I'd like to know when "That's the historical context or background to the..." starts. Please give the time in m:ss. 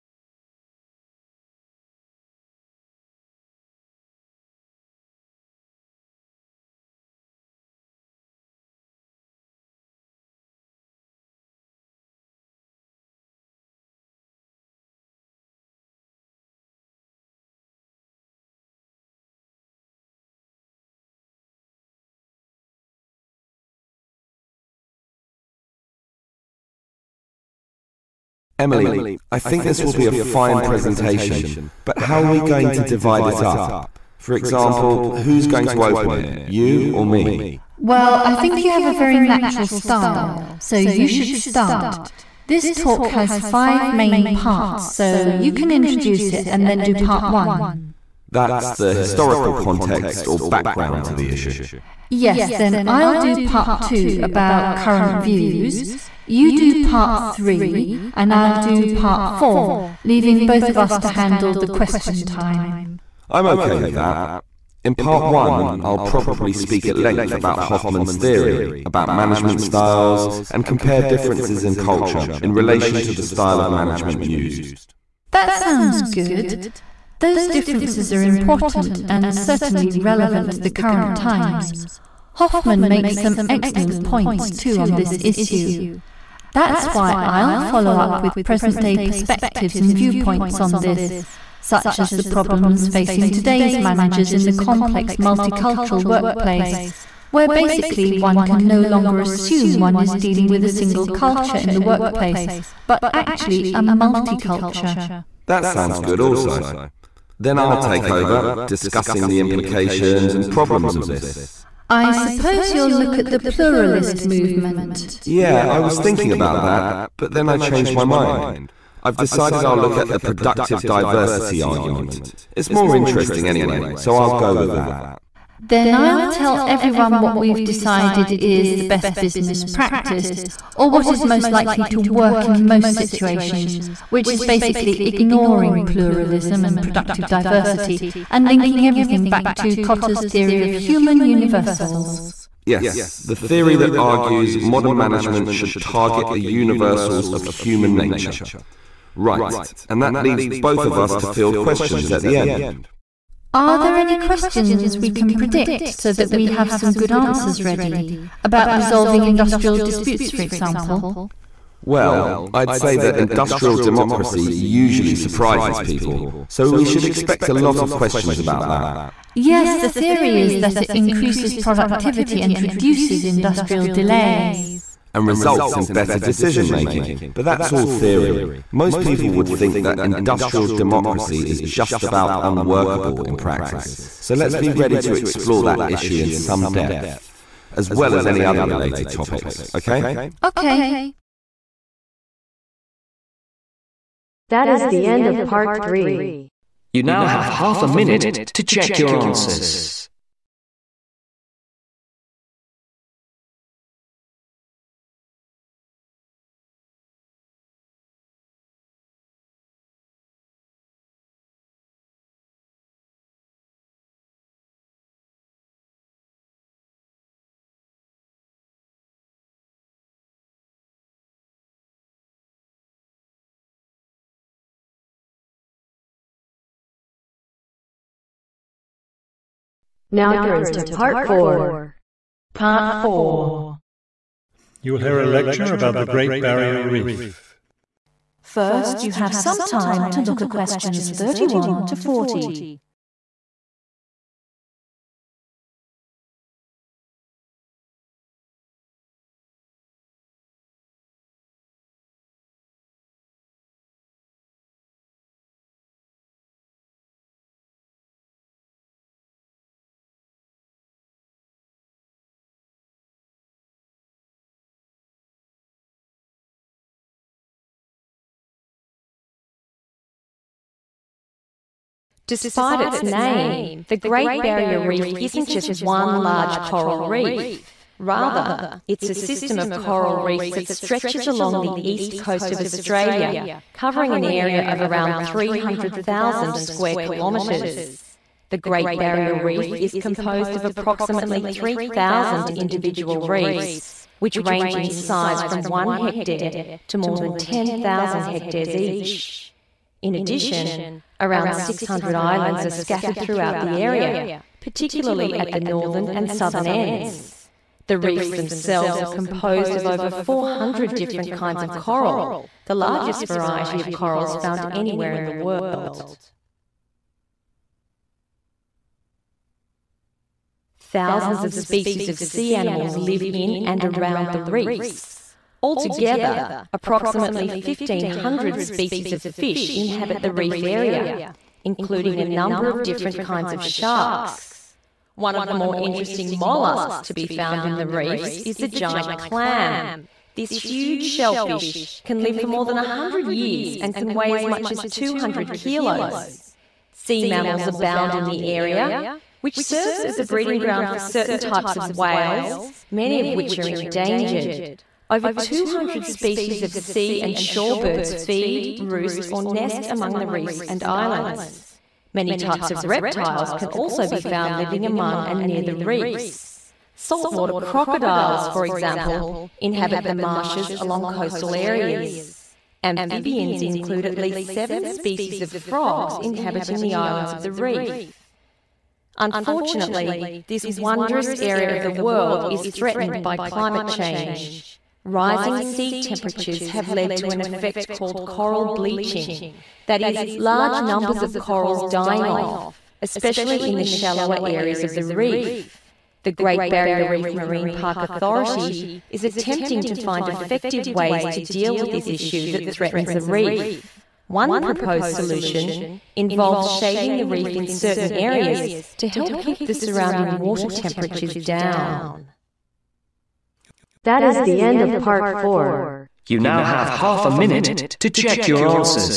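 0:48.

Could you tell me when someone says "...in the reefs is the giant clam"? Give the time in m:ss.
5:37.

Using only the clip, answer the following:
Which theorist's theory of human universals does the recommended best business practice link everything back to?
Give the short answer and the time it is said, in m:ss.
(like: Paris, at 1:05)
Cotter, at 2:19.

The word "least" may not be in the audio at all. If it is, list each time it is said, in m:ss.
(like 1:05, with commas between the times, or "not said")
6:14.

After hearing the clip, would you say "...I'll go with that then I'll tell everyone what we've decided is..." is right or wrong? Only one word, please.
right.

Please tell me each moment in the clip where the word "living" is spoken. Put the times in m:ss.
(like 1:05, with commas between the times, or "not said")
6:04.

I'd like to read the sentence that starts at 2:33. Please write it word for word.
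Are there any questions we can predict so that we have some good answers ready about resolving industrial disputes, for example?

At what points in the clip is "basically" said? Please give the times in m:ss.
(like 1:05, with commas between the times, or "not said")
1:37, 2:14.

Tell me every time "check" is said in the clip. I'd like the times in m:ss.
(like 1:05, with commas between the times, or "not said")
3:18, 6:58.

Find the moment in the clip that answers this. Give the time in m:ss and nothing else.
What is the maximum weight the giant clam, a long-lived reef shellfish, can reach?
5:44.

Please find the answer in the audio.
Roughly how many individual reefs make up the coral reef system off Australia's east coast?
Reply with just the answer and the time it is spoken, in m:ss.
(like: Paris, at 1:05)
3,000, at 4:51.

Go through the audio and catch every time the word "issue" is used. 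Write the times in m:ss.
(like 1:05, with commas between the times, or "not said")
0:51, 1:25, 3:05, 6:42.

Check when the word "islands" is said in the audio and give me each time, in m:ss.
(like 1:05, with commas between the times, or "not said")
5:02, 6:00, 6:16.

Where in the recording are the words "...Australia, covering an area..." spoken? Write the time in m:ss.
4:42.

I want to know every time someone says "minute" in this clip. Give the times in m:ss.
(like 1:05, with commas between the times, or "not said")
3:17, 6:57.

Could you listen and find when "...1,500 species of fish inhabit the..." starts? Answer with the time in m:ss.
5:27.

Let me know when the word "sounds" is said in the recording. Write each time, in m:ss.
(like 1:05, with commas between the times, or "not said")
1:15, 1:45.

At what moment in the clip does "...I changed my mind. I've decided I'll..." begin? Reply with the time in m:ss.
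1:57.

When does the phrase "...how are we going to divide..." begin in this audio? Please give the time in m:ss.
0:31.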